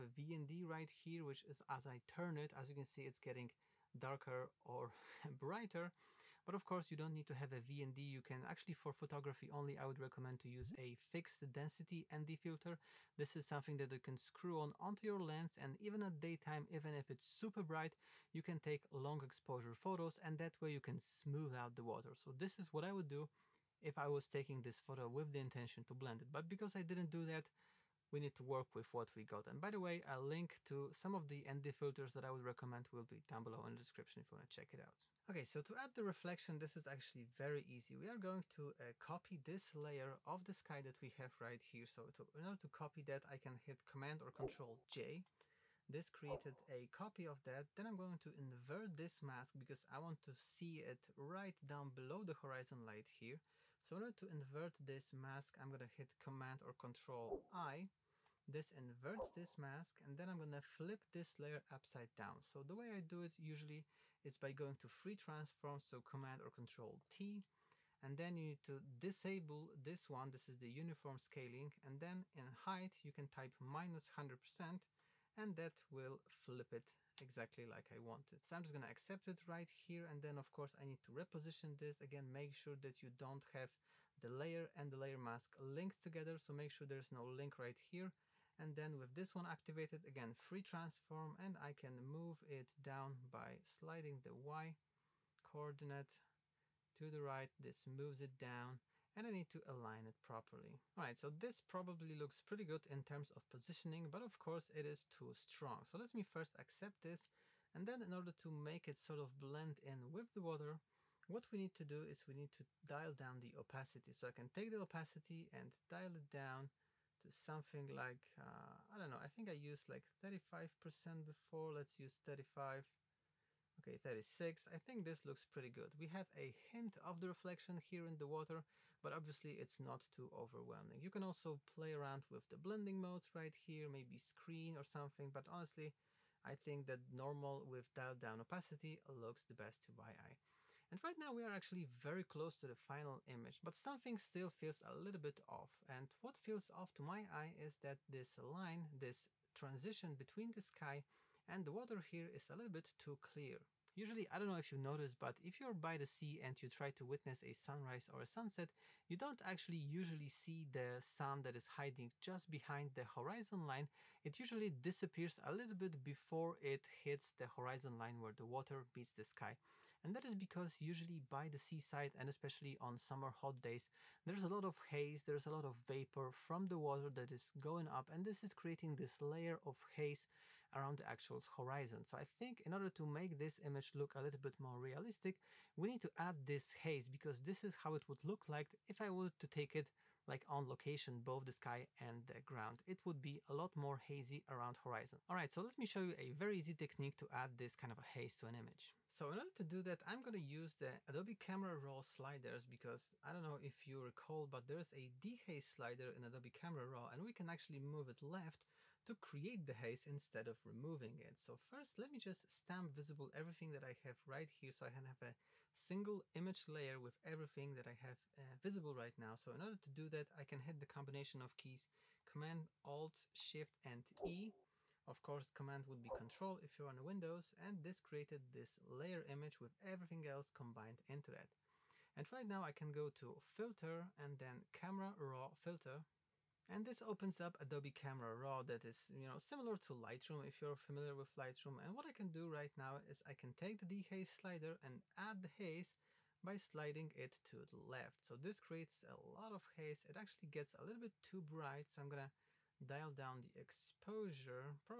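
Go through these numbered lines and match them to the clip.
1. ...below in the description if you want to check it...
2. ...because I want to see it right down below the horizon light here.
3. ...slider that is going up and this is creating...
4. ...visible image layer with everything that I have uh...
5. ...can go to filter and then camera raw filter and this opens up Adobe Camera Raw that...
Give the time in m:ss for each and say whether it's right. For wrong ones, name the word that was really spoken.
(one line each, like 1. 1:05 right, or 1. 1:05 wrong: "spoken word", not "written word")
1. 0:33 right
2. 0:49 right
3. 2:56 wrong: "water", not "slider"
4. 3:35 wrong: "single", not "visible"
5. 3:52 right.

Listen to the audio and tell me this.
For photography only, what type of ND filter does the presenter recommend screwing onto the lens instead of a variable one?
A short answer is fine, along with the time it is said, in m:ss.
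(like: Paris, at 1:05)
Fixed density ND filter, at 0:11.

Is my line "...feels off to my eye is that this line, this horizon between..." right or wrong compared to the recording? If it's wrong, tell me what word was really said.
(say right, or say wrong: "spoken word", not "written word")
wrong: "transition", not "horizon".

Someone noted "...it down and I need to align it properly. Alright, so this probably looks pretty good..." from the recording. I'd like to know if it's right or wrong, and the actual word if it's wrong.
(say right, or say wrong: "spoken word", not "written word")
right.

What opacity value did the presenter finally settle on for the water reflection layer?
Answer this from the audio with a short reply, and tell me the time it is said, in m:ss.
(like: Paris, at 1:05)
36%, at 2:03.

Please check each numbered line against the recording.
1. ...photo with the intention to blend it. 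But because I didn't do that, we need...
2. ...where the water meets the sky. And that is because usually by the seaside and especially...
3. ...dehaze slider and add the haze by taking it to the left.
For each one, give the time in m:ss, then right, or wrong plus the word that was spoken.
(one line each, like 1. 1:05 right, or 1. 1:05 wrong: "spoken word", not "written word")
1. 0:24 right
2. 2:48 right
3. 4:03 wrong: "sliding", not "taking".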